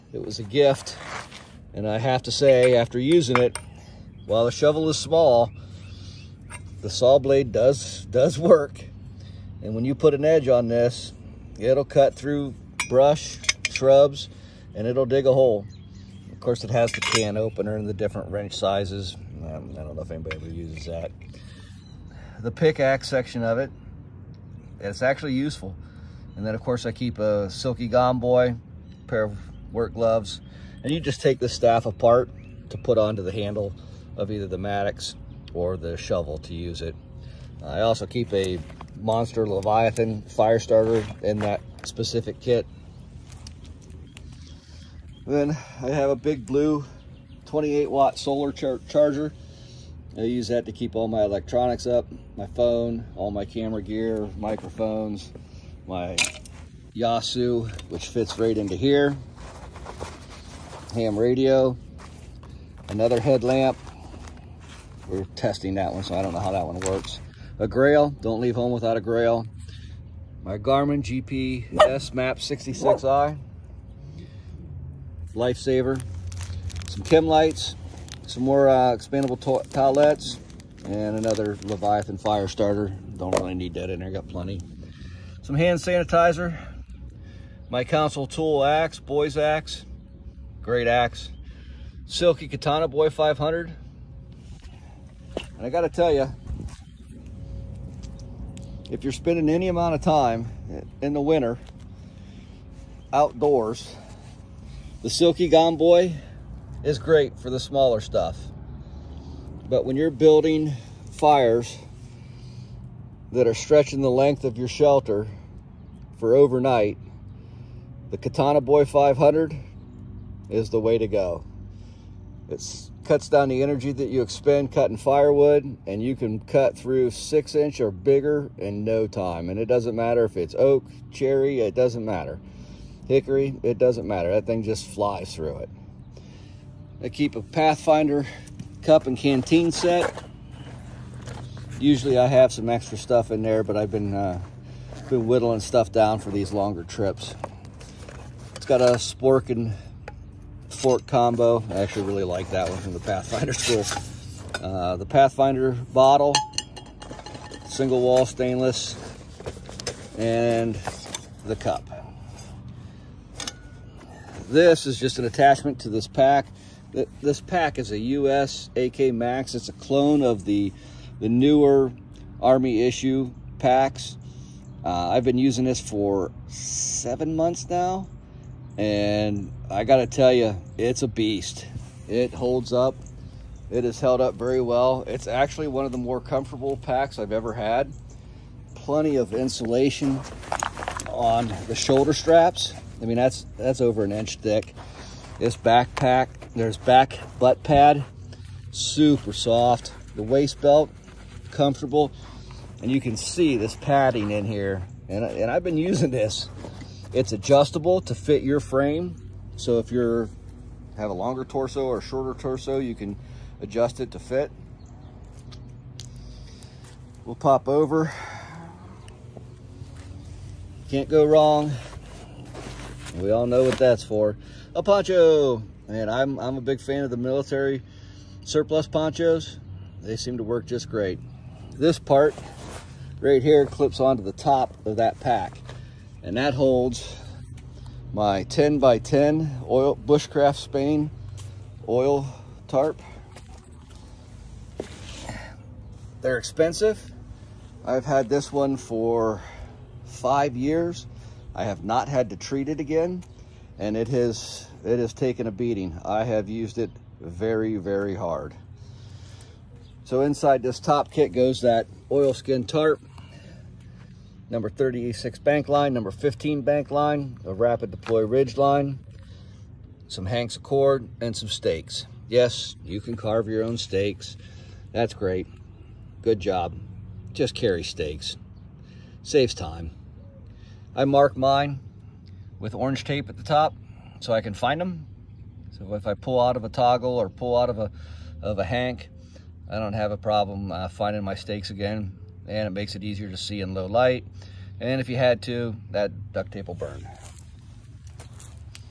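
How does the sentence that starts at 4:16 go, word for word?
I have used it very, very hard.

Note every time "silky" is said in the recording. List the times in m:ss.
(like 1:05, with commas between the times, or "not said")
0:27, 1:32, 1:45.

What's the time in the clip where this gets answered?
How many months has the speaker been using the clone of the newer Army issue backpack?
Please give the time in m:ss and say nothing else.
2:56.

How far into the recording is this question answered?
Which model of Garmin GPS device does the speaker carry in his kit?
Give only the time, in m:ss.
1:11.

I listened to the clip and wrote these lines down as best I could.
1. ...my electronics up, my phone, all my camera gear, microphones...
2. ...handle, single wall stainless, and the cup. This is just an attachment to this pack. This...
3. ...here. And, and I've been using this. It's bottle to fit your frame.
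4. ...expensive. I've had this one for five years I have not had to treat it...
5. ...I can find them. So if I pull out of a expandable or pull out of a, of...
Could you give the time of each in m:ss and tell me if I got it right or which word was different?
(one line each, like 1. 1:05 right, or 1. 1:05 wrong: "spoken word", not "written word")
1. 0:51 right
2. 2:35 wrong: "bottle", not "handle"
3. 3:24 wrong: "adjustable", not "bottle"
4. 4:06 right
5. 4:44 wrong: "toggle", not "expandable".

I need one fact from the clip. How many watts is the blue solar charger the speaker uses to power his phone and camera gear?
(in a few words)
28.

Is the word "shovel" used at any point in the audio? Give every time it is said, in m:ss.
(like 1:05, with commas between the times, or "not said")
0:04, 0:35.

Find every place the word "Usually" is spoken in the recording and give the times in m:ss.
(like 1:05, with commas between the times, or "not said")
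2:21.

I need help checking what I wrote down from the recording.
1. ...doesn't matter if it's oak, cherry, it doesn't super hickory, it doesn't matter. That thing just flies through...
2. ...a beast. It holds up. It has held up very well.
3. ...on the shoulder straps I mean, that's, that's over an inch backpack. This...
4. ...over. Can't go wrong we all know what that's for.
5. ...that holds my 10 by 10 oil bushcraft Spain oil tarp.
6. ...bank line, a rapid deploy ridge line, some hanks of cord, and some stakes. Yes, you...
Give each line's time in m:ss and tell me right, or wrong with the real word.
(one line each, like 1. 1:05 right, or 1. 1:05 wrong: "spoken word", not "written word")
1. 2:09 wrong: "matter", not "super"
2. 3:01 right
3. 3:11 wrong: "thick", not "backpack"
4. 3:37 right
5. 3:56 right
6. 4:26 right.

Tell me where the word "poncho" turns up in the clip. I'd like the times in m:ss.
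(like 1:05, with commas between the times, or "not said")
3:44, 3:48.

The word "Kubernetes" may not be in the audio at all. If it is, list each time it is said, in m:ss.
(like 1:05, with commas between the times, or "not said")
not said.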